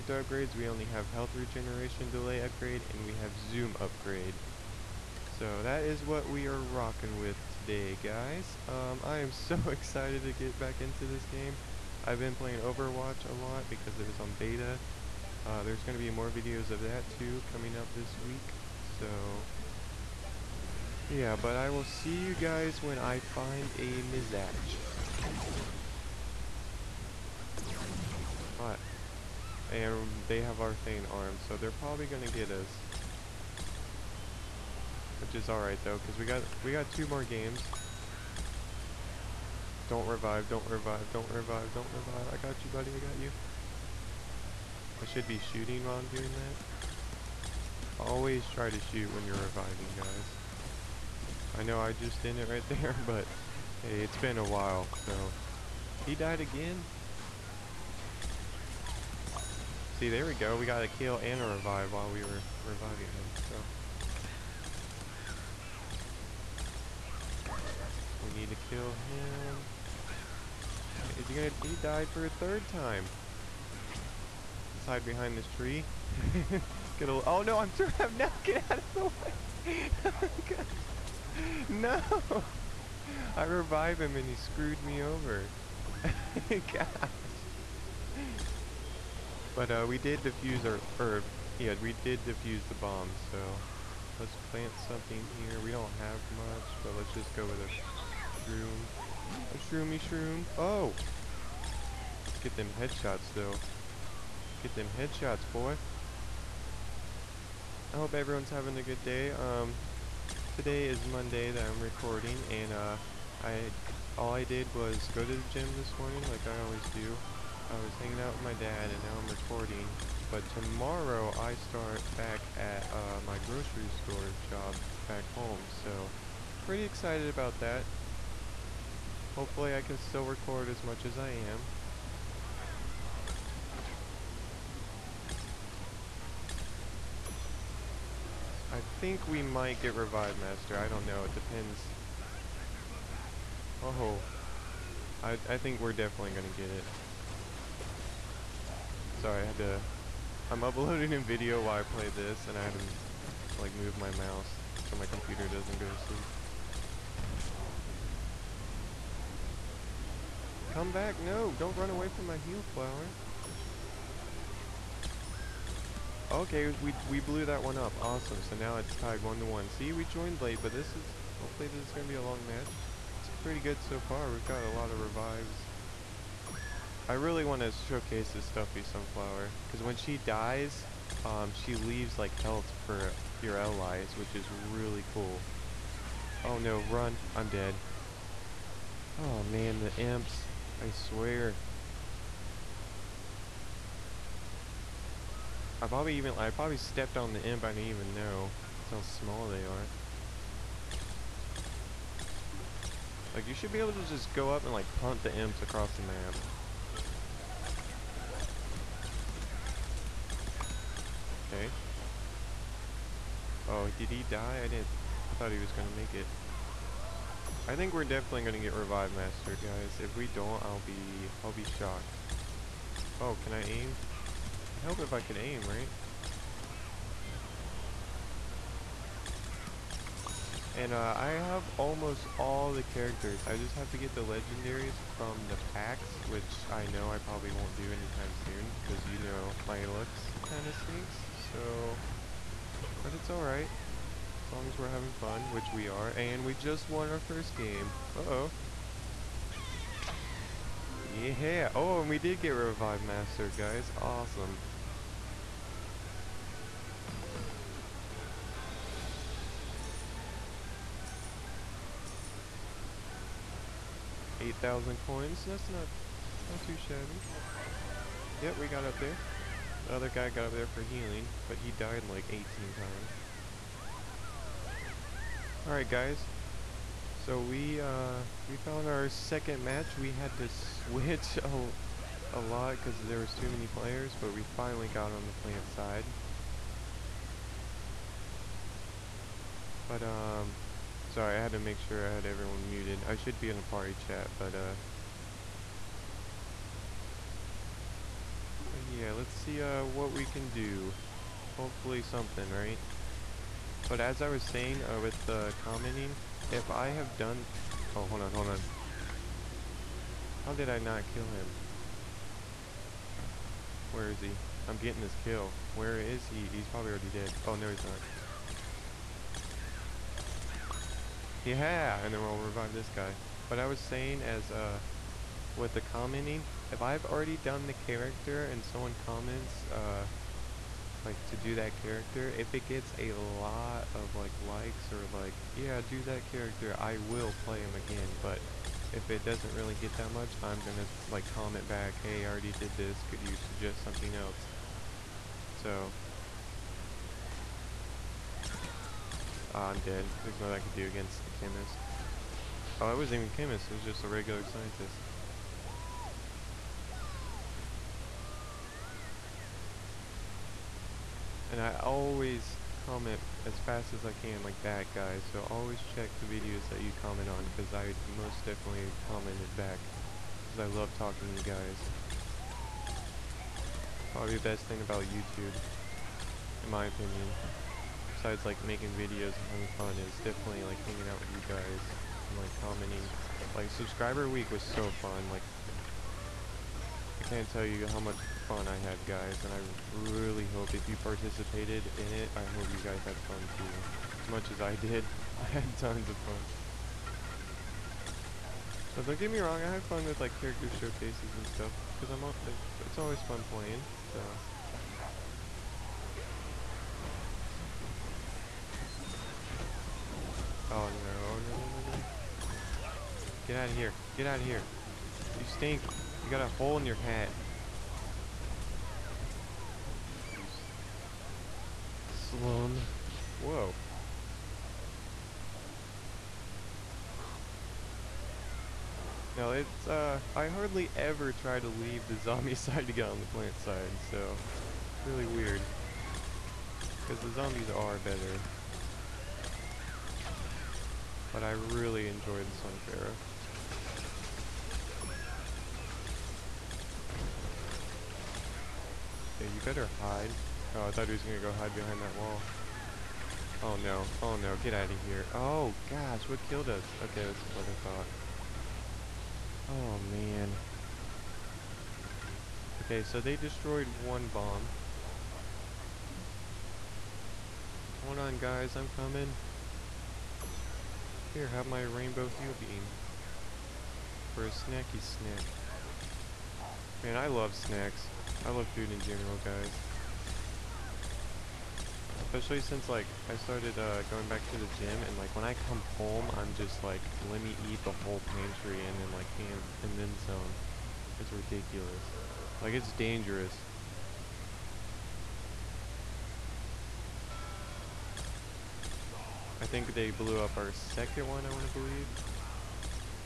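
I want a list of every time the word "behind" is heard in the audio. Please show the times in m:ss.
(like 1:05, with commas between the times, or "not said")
1:15, 7:31.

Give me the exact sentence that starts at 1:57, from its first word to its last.
I was hanging out with my dad, and now I'm recording.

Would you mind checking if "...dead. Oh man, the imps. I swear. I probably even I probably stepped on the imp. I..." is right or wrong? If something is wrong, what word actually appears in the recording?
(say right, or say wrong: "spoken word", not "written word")
right.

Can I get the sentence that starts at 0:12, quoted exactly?
I've been playing Overwatch a lot because it was on beta.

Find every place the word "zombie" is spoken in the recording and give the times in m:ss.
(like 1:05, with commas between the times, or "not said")
7:12, 7:17.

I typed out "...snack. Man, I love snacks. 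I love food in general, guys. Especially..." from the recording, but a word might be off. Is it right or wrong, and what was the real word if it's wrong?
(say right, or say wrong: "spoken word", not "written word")
right.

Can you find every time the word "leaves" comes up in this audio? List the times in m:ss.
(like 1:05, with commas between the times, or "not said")
3:01, 7:11.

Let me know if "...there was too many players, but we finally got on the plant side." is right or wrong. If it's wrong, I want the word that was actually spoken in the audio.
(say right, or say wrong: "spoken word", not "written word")
right.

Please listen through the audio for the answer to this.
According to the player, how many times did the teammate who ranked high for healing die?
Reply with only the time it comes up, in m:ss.
4:32.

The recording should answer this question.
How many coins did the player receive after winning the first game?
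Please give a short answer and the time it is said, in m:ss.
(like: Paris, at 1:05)
8,000, at 4:24.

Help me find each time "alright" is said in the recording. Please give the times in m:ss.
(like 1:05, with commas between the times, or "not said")
0:35, 4:03, 4:35.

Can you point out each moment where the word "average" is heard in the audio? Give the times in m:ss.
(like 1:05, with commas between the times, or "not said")
not said.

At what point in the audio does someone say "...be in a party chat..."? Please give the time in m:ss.
4:53.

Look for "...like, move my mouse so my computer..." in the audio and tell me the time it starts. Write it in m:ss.
2:33.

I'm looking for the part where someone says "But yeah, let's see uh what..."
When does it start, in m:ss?
4:58.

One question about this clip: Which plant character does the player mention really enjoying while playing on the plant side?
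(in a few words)
Sun Pharaoh.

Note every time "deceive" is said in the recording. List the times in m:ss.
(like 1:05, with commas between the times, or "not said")
not said.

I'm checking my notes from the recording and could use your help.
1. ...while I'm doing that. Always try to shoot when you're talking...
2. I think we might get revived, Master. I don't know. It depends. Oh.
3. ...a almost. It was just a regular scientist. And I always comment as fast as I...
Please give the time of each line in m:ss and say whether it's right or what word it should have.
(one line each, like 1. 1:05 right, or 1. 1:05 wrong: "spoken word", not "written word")
1. 0:45 wrong: "reviving", not "talking"
2. 2:18 right
3. 5:53 wrong: "chemist", not "almost".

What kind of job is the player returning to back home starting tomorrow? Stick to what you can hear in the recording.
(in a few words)
Grocery store job.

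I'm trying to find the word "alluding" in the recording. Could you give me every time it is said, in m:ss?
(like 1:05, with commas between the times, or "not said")
not said.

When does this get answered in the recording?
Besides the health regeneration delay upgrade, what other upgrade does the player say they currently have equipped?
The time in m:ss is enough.
0:03.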